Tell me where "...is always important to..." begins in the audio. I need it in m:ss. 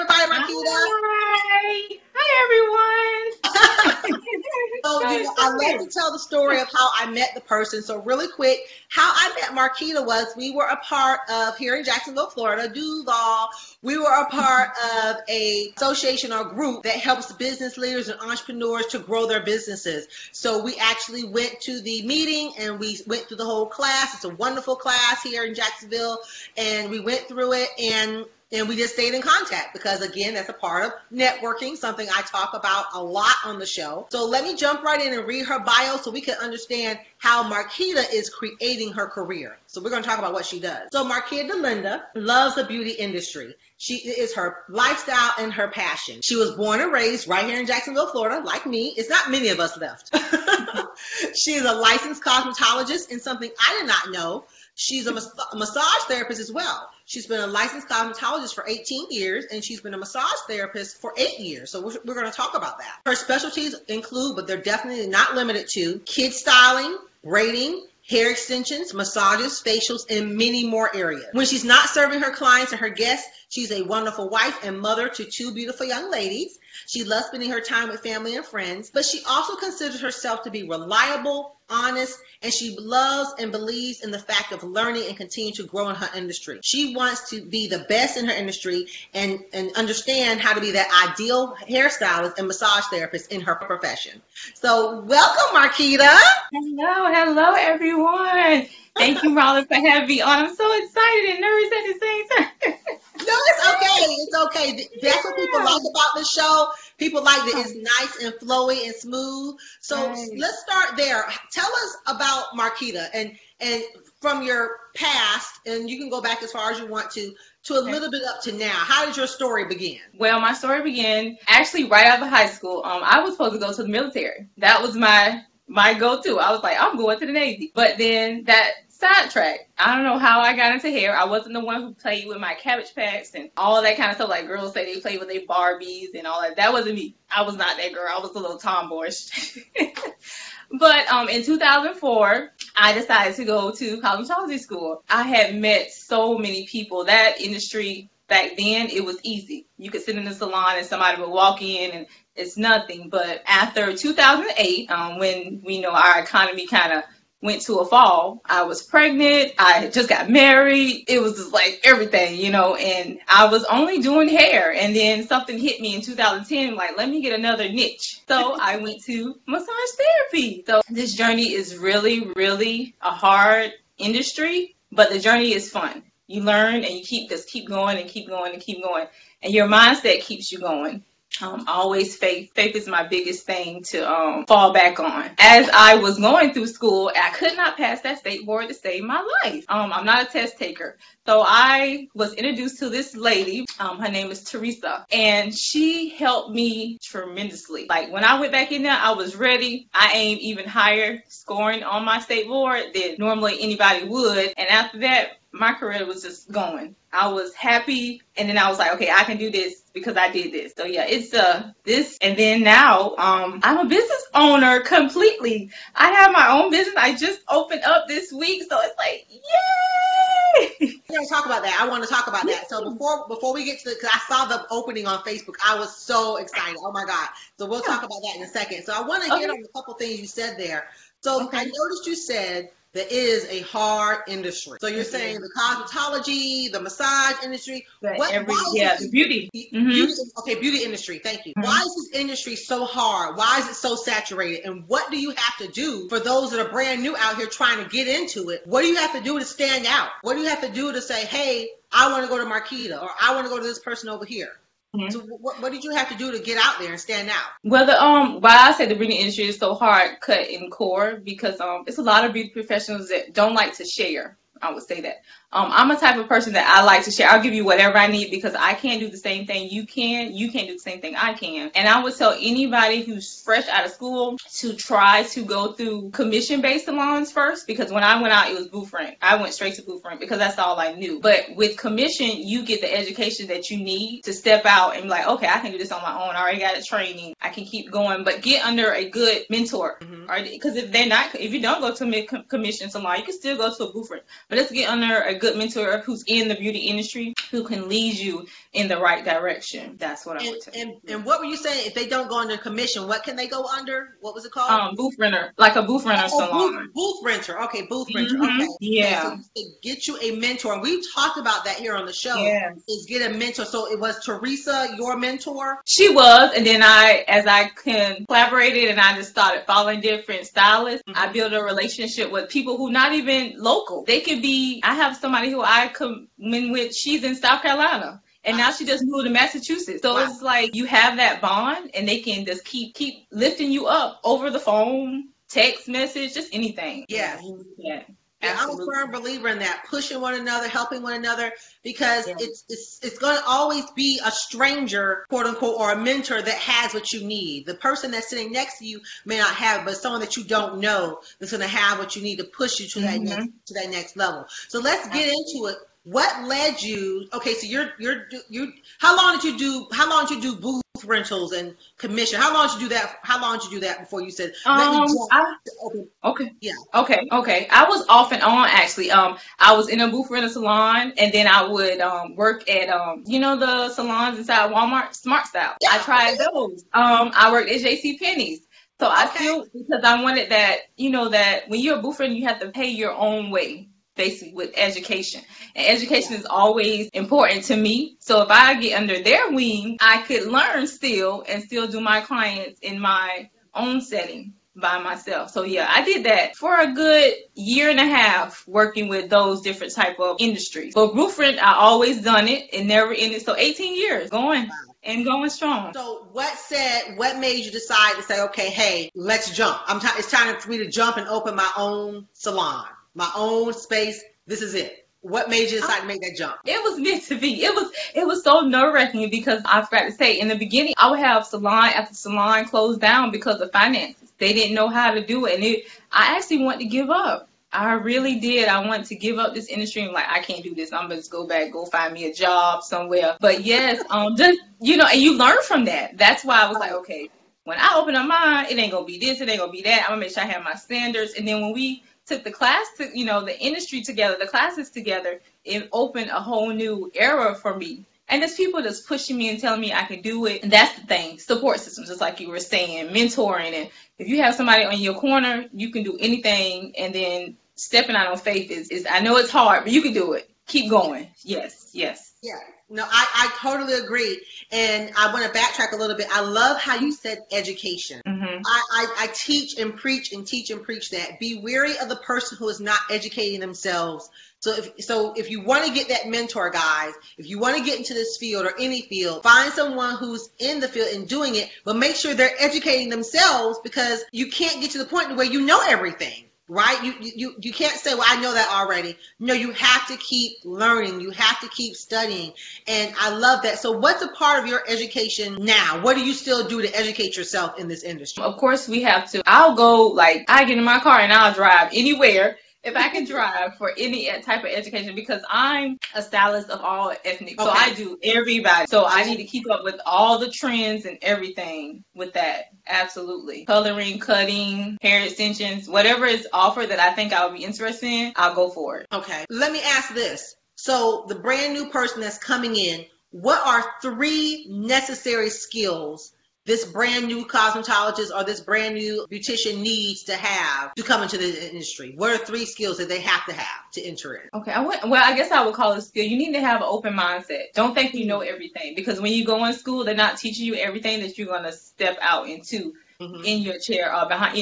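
6:26.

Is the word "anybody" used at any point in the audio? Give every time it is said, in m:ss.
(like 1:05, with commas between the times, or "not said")
3:23, 4:32.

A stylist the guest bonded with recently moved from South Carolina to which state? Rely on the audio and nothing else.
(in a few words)
Massachusetts.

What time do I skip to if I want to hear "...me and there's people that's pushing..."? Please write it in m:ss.
7:27.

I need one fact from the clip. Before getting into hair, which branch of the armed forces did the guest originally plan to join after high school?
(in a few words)
Navy.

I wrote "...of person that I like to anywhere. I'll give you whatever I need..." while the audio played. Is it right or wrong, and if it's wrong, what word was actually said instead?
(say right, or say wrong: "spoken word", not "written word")
wrong: "share", not "anywhere".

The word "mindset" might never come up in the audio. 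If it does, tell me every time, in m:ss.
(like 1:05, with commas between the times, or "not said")
2:59, 8:57.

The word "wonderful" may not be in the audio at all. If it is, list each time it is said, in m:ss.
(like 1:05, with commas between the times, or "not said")
0:24, 1:13.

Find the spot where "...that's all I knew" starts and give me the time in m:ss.
4:40.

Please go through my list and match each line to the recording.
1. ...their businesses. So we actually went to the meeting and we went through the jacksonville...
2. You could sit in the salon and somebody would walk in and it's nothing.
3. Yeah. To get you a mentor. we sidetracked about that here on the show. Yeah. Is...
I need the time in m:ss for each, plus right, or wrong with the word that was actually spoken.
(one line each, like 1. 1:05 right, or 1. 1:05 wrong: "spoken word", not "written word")
1. 0:19 wrong: "whole", not "jacksonville"
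2. 2:29 right
3. 5:08 wrong: "talked", not "sidetracked".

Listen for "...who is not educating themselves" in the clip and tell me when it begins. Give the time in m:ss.
7:52.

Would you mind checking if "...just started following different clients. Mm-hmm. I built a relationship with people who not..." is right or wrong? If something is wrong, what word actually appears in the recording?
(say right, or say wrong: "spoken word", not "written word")
wrong: "stylists", not "clients".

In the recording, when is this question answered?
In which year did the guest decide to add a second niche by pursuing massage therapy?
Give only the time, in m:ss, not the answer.
2:46.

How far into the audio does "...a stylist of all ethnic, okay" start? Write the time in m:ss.
8:26.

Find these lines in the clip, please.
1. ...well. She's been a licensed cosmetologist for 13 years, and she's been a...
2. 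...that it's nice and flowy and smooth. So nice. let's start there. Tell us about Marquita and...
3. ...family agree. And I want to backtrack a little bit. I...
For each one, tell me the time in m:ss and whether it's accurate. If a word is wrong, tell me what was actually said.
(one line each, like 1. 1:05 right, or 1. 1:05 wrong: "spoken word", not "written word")
1. 0:56 wrong: "18", not "13"
2. 1:47 right
3. 7:43 wrong: "totally", not "family".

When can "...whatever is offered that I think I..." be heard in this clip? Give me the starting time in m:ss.
8:35.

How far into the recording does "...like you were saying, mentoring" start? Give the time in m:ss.
7:32.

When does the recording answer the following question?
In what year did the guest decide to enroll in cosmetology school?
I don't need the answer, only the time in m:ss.
2:21.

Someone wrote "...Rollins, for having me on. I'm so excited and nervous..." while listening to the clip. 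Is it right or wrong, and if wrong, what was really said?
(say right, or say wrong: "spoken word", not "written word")
right.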